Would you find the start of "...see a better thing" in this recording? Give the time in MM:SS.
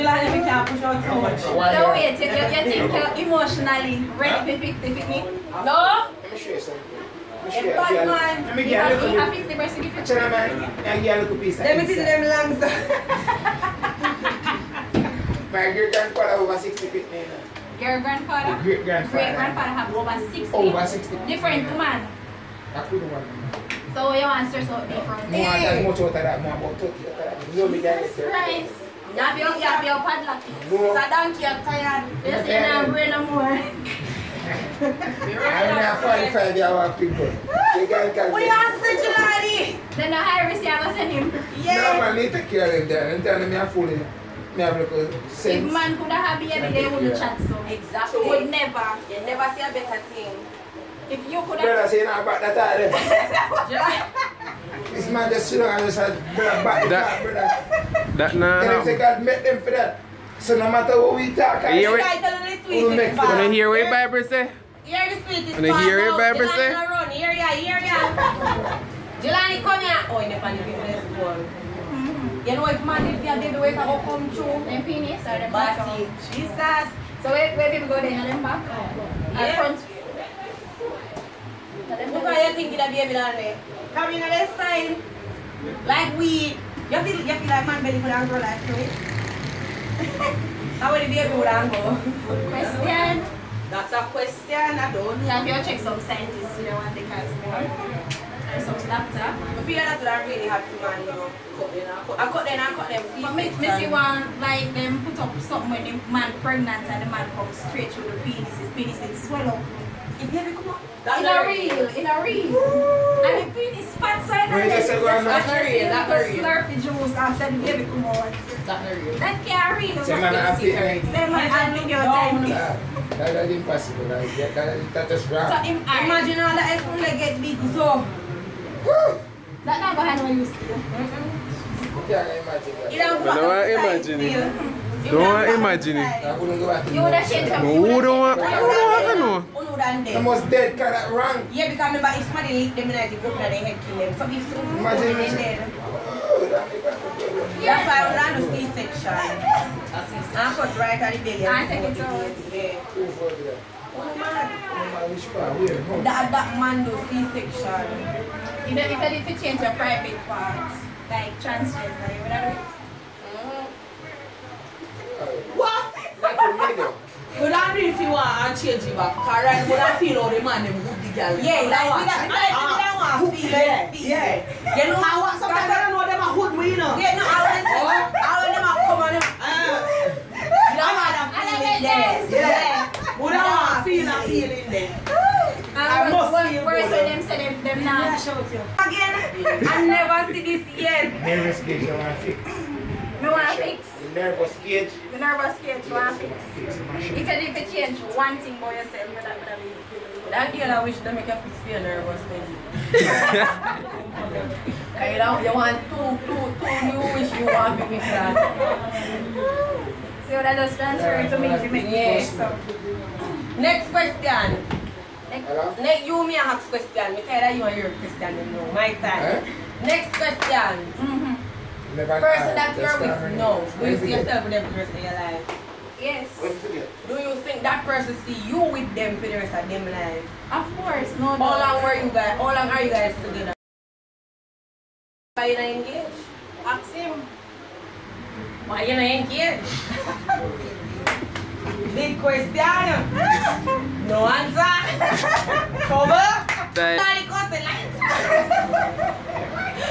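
00:49.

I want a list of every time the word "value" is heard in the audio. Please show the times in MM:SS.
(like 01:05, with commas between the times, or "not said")
not said.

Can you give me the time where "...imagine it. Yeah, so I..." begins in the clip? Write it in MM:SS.
02:24.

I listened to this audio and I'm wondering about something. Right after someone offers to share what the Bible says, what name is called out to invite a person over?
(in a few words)
Jelani.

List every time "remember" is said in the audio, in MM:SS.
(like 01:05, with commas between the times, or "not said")
02:21.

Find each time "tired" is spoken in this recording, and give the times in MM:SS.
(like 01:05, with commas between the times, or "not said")
00:31.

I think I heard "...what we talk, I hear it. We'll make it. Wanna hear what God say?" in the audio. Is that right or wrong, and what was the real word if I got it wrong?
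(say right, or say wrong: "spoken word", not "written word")
wrong: "Bible", not "God".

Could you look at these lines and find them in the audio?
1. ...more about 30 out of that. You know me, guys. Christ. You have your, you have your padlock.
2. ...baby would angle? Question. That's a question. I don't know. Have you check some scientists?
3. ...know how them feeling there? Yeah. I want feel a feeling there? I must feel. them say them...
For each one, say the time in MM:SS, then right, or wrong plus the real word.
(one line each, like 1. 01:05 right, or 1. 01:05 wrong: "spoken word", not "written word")
1. 00:26 right
2. 01:31 right
3. 03:00 right.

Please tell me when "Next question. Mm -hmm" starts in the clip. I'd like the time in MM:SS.
03:39.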